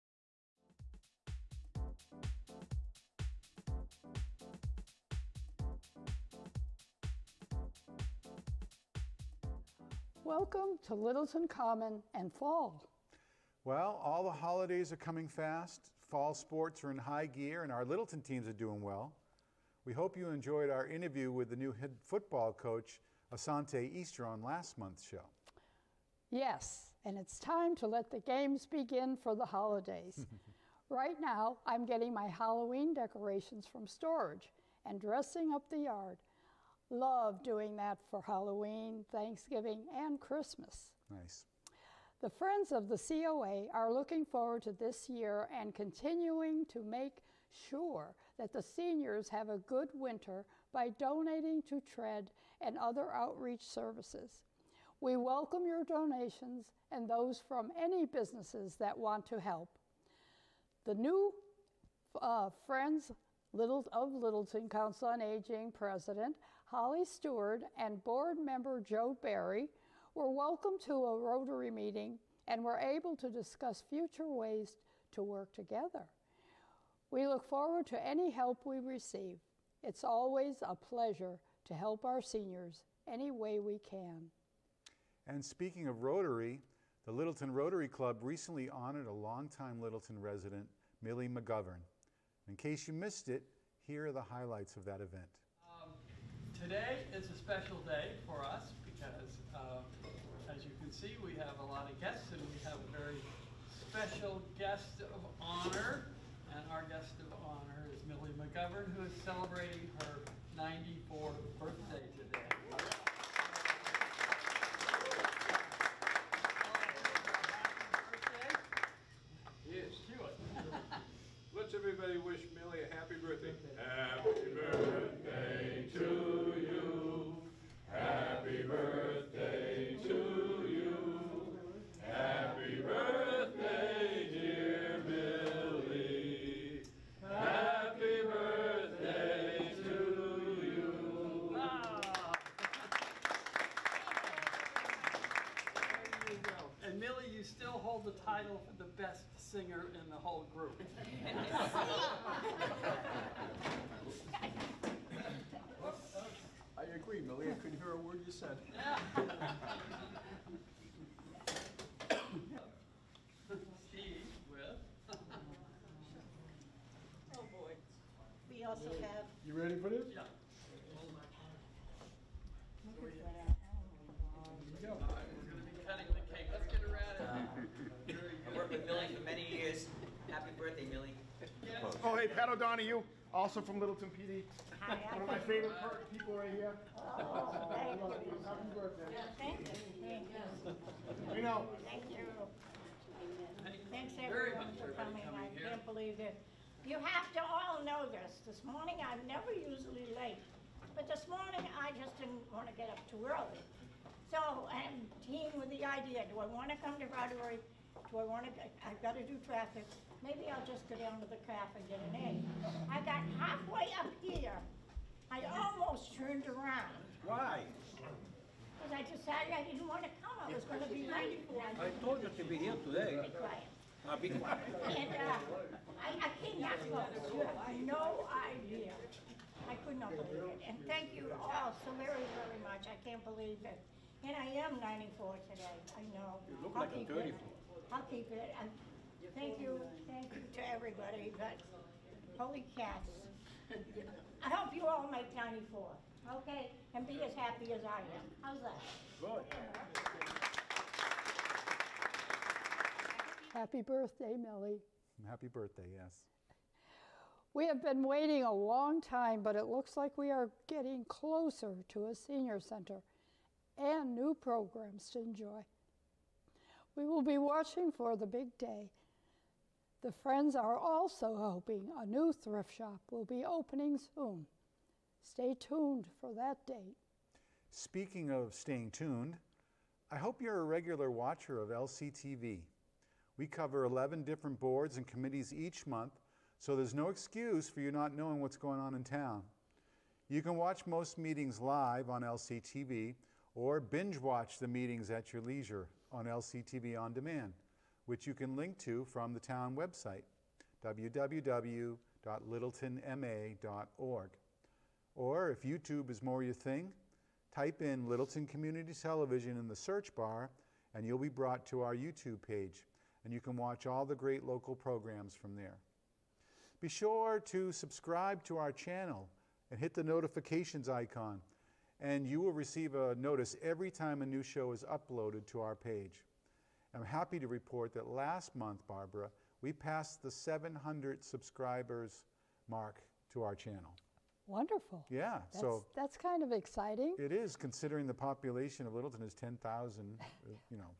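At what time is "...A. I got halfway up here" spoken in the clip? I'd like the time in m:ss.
3:32.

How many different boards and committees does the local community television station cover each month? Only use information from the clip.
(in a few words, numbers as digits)
11.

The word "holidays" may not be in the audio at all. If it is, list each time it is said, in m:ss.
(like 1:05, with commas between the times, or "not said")
0:14, 0:29.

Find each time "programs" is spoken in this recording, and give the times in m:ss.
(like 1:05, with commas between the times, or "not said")
4:24, 5:14.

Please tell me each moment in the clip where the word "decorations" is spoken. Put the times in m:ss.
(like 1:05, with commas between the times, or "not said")
0:32.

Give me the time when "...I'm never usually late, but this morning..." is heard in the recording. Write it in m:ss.
3:18.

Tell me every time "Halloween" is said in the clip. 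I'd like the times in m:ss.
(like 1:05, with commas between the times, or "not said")
0:32, 0:38.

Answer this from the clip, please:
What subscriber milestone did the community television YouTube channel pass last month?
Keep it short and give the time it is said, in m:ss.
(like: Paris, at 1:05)
700, at 5:30.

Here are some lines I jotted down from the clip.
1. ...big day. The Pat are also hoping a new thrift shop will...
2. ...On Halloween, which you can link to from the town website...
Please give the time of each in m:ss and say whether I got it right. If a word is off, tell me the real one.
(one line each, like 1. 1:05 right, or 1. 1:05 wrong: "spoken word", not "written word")
1. 4:28 wrong: "Friends", not "Pat"
2. 4:57 wrong: "Demand", not "Halloween".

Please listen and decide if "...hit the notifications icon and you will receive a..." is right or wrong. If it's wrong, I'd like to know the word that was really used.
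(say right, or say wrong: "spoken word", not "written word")
right.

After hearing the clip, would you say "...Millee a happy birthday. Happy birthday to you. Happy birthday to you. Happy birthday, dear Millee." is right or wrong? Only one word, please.
right.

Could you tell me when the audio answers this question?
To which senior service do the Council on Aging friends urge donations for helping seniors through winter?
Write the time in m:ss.
0:51.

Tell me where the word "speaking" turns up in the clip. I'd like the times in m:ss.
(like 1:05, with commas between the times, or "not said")
1:25, 4:37.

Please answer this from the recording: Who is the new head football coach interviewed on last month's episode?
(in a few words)
Asante Easter.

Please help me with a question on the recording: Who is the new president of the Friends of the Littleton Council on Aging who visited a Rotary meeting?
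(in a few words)
Holly Stewart.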